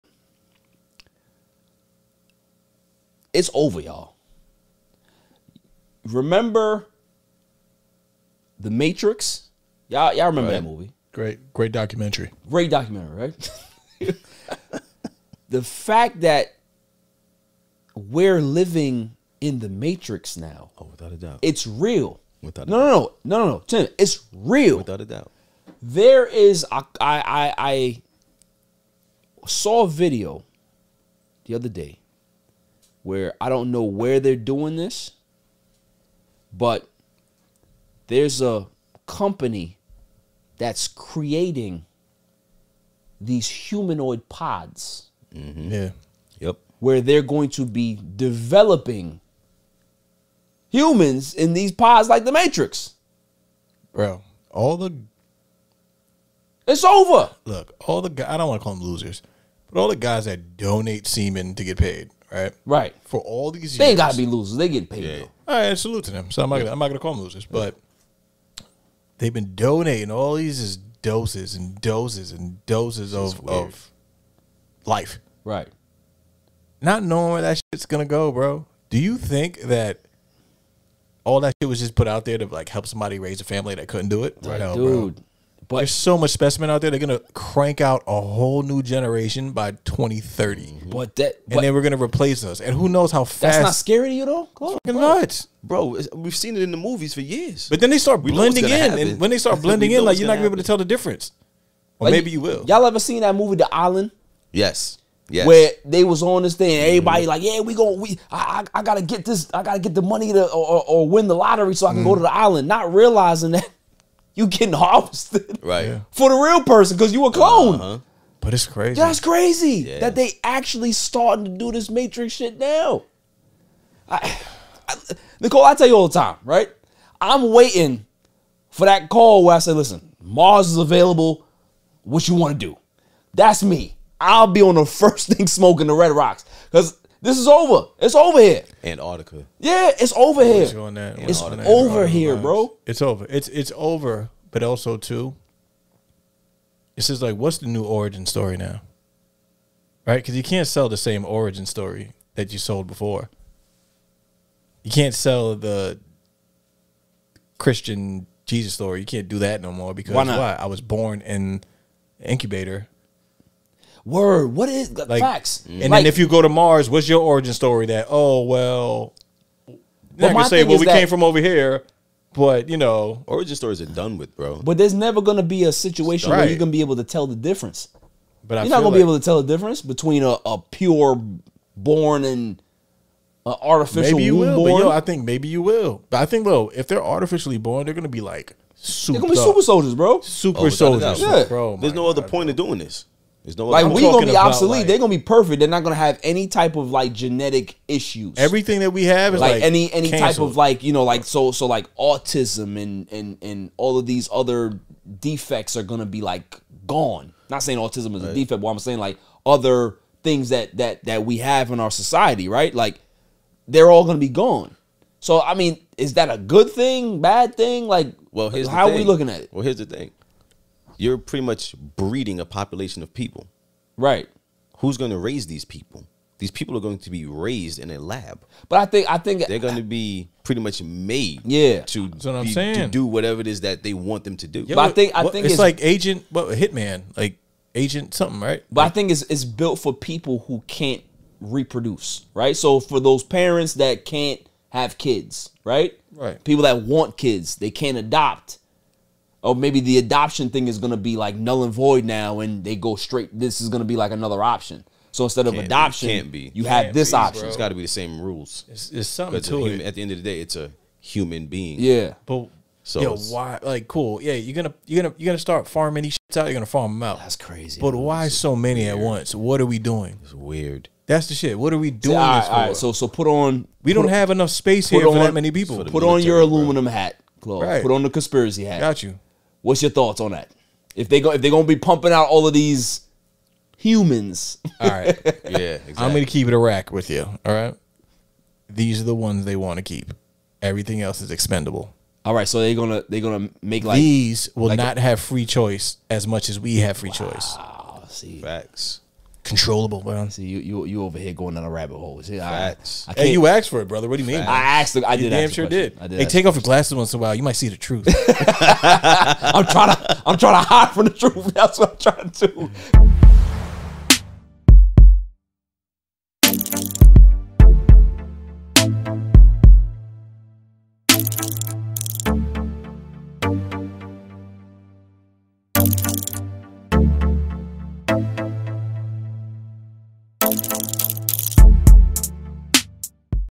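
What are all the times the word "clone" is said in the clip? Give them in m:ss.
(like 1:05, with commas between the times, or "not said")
1:57.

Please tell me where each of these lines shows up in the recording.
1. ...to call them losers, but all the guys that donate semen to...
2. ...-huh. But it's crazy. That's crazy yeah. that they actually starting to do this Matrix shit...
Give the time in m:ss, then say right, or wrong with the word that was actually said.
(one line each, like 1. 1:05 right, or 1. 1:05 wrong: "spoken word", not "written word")
1. 0:58 right
2. 1:57 right.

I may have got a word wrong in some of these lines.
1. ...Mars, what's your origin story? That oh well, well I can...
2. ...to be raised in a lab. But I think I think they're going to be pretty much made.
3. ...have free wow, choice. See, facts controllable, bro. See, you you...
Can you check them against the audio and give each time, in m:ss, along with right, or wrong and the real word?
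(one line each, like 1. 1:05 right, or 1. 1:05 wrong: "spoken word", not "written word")
1. 2:46 right
2. 3:46 right
3. 4:56 right.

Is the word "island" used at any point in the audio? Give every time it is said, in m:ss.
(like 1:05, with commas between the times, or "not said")
1:43, 1:52.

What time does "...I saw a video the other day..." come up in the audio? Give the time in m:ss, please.
0:27.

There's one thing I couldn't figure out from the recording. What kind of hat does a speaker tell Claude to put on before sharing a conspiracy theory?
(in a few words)
Aluminum hat.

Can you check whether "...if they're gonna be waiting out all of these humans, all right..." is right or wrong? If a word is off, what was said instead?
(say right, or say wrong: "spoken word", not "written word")
wrong: "pumping", not "waiting".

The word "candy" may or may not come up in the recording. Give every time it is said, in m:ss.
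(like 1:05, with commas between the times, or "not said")
not said.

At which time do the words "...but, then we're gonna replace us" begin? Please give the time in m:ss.
1:31.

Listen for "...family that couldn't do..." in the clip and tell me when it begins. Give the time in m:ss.
1:23.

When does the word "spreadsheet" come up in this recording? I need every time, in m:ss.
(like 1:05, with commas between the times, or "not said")
not said.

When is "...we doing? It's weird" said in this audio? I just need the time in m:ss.
4:29.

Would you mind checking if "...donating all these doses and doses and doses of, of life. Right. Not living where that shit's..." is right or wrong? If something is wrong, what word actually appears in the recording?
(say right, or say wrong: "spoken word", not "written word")
wrong: "knowing", not "living".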